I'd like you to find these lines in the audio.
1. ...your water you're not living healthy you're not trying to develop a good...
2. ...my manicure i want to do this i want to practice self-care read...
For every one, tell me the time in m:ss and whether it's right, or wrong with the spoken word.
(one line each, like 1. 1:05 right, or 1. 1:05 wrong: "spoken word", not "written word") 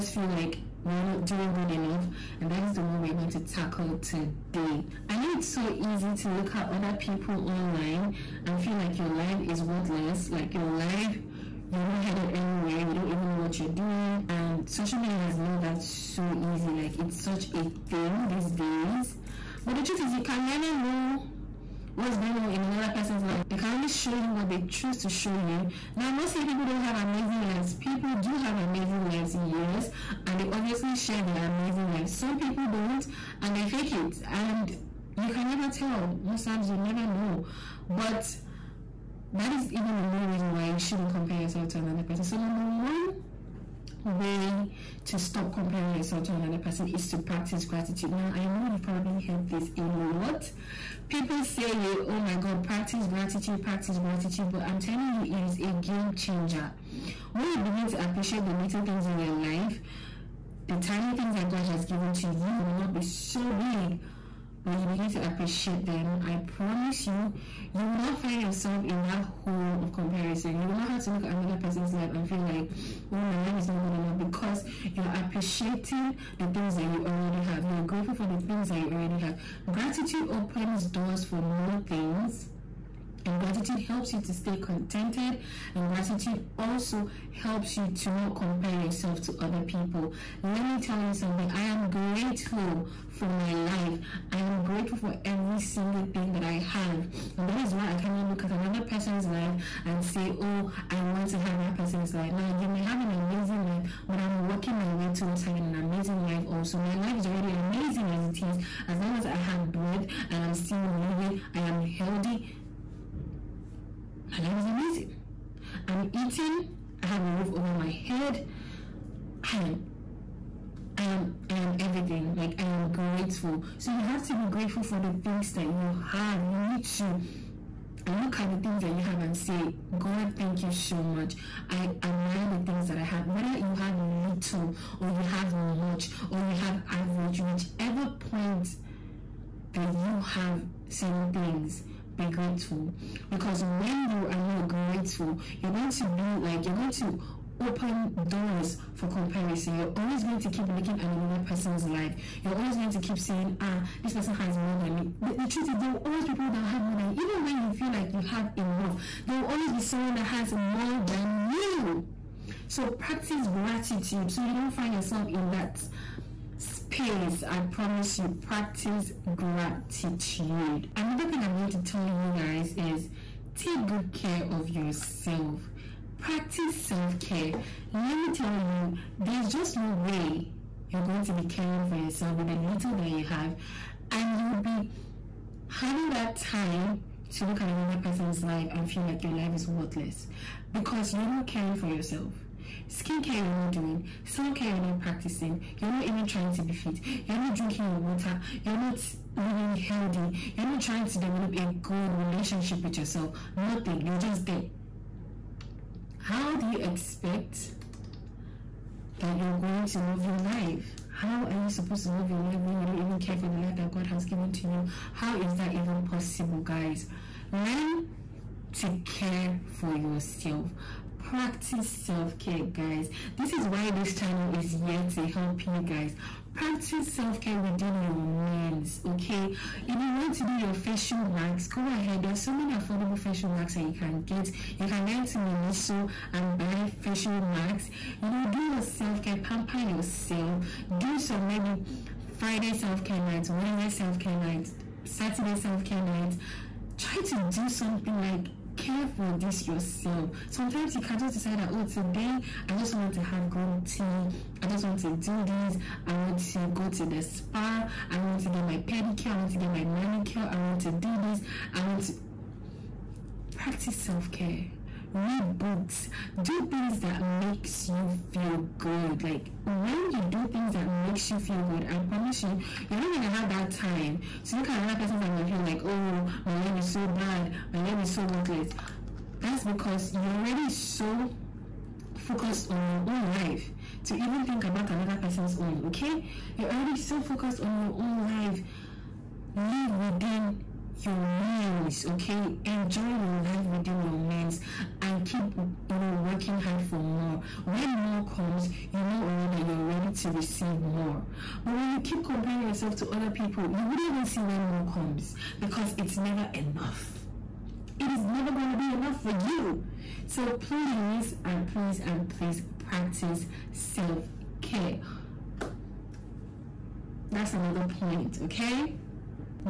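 1. 3:17 right
2. 4:19 right.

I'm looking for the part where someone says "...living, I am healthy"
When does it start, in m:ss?
1:50.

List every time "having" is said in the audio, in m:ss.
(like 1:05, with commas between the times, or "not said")
1:45, 3:05.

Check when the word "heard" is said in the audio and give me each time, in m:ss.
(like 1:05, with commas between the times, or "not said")
0:49.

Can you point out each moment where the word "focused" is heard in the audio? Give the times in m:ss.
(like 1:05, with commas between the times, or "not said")
4:42, 4:47.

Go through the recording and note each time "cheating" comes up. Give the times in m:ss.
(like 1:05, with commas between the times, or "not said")
not said.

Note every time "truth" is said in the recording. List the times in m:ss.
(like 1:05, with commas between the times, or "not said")
0:19, 2:35.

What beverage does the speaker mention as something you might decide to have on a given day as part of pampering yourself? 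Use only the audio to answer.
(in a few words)
Green tea.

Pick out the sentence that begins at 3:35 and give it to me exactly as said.
How is that even possible, guys?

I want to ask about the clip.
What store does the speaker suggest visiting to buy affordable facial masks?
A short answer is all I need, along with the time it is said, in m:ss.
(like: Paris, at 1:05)
Miniso, at 3:55.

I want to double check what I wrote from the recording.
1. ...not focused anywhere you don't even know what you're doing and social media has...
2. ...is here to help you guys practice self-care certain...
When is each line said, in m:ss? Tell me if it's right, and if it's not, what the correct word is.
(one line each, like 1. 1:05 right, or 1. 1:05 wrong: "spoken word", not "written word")
1. 0:11 wrong: "headed", not "focused"
2. 3:44 wrong: "within", not "certain".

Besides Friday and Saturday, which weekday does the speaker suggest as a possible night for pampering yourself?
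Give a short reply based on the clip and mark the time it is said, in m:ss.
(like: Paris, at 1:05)
Wednesday, at 4:03.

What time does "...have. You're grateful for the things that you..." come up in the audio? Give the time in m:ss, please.
1:17.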